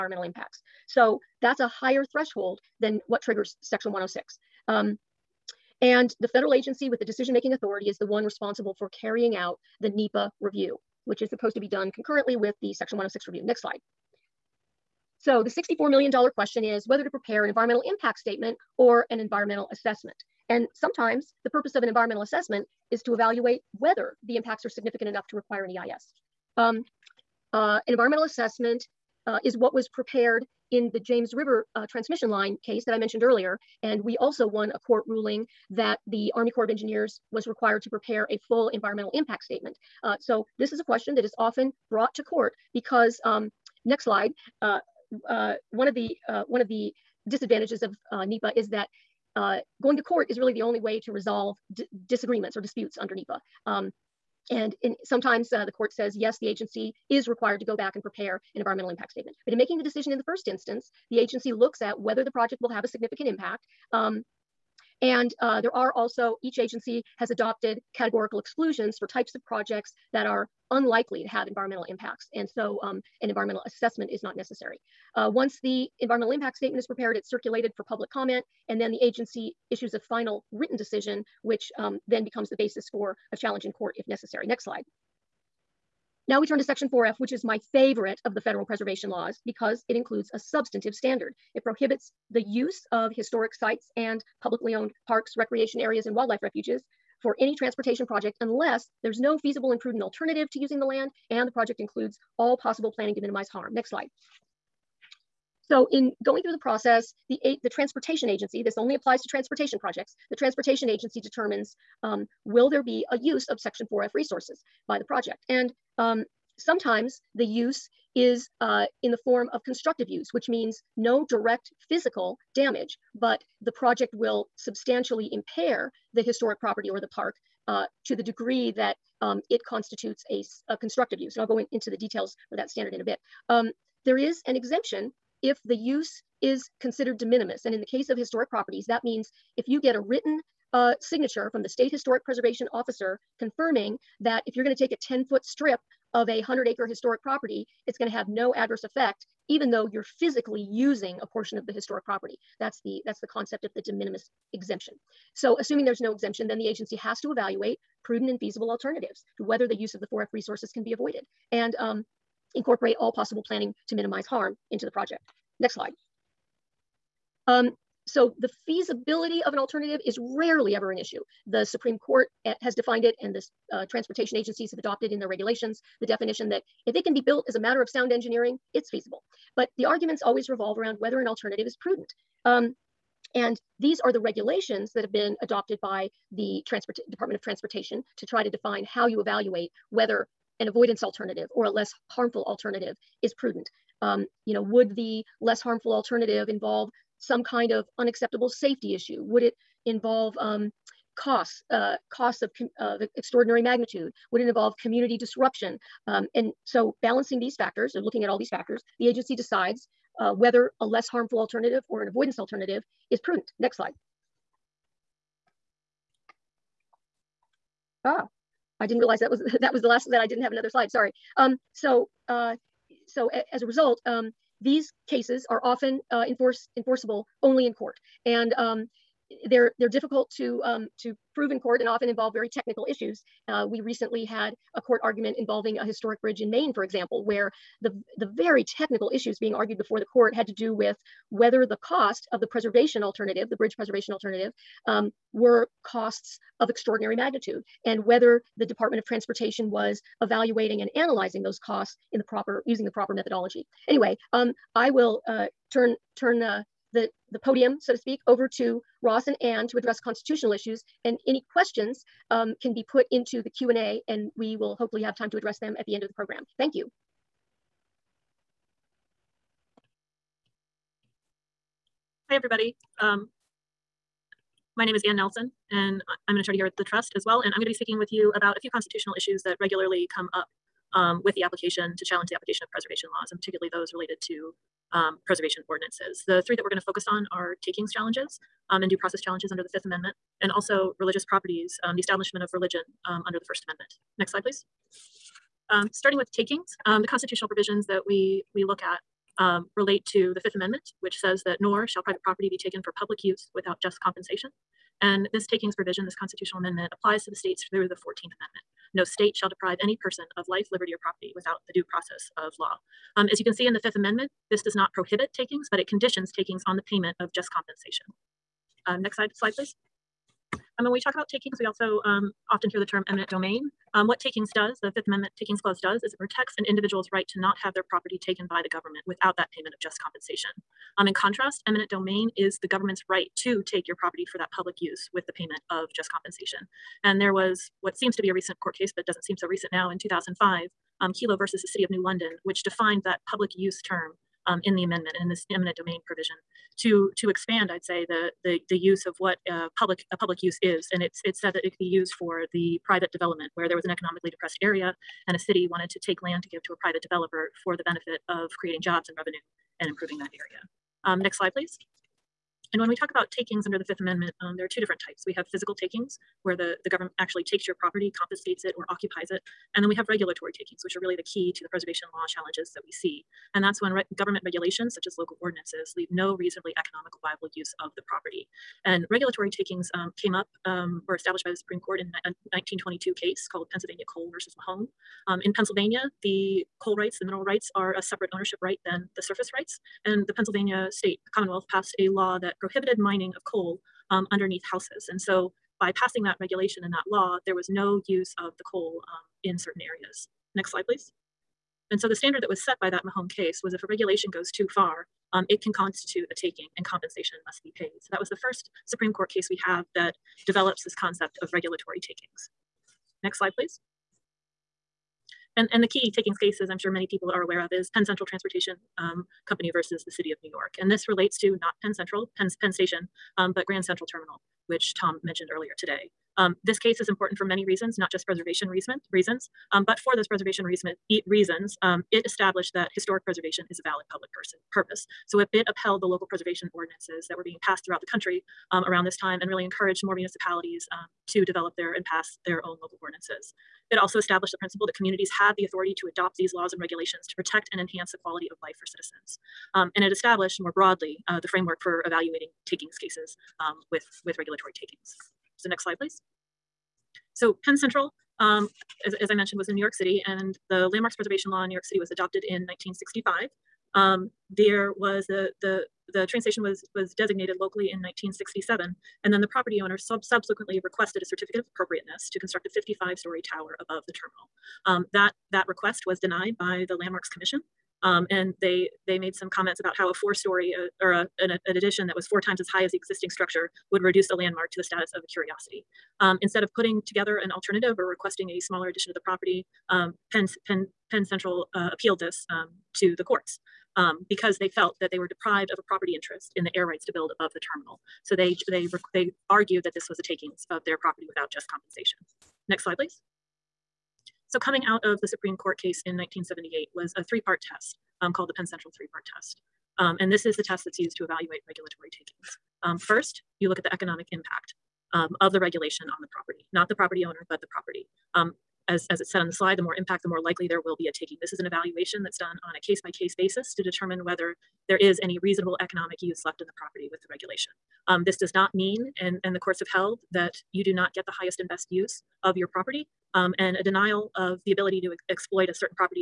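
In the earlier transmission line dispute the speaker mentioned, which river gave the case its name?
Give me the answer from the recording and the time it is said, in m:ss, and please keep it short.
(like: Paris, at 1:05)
James River, at 0:30.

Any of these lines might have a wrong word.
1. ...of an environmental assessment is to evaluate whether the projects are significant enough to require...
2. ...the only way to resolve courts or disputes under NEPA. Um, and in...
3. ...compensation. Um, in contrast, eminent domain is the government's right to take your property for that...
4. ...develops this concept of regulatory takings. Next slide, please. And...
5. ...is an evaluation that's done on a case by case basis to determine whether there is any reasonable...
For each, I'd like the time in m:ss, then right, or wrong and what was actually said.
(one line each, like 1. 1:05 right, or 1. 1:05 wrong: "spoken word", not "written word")
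1. 0:21 wrong: "impacts", not "projects"
2. 0:50 wrong: "disagreements", not "courts"
3. 5:29 right
4. 6:50 right
5. 8:41 right.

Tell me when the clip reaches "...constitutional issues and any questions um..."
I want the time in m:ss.
4:19.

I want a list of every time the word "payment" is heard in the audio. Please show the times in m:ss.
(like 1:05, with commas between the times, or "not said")
5:16, 5:29, 5:35.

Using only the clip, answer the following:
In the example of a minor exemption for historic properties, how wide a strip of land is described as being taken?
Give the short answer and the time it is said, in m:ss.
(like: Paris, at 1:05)
10 foot, at 2:25.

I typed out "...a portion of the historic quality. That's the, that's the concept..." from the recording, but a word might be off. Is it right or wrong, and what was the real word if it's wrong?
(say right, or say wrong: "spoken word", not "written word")
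wrong: "property", not "quality".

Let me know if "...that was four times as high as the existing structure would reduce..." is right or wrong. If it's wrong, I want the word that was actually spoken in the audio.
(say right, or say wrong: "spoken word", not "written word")
right.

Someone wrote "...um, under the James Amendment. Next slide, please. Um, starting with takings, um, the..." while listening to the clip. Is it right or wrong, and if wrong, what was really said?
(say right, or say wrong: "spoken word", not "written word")
wrong: "First", not "James".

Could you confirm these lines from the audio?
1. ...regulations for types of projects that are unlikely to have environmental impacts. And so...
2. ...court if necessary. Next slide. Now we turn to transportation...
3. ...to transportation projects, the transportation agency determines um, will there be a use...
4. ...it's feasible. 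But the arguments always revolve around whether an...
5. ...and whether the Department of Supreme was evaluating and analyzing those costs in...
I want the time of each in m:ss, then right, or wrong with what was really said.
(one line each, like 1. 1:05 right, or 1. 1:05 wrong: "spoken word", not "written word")
1. 1:08 wrong: "exclusions", not "regulations"
2. 1:23 wrong: "section", not "transportation"
3. 1:49 right
4. 2:58 right
5. 4:07 wrong: "Transportation", not "Supreme".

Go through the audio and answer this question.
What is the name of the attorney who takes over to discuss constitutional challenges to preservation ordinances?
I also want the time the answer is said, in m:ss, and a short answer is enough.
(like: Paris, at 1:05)
Anne Nelson, at 4:35.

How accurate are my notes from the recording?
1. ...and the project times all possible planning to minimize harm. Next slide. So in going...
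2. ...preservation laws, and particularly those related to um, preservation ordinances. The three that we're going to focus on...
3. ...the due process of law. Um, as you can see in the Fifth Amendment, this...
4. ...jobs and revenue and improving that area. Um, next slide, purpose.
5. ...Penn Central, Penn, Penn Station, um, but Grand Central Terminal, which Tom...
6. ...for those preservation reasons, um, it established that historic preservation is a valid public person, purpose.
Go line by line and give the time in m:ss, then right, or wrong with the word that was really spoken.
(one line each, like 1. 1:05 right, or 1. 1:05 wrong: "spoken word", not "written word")
1. 1:41 wrong: "includes", not "times"
2. 4:42 right
3. 5:11 right
4. 5:58 wrong: "please", not "purpose"
5. 7:01 right
6. 7:09 right.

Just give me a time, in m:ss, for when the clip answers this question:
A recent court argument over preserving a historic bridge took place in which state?
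3:56.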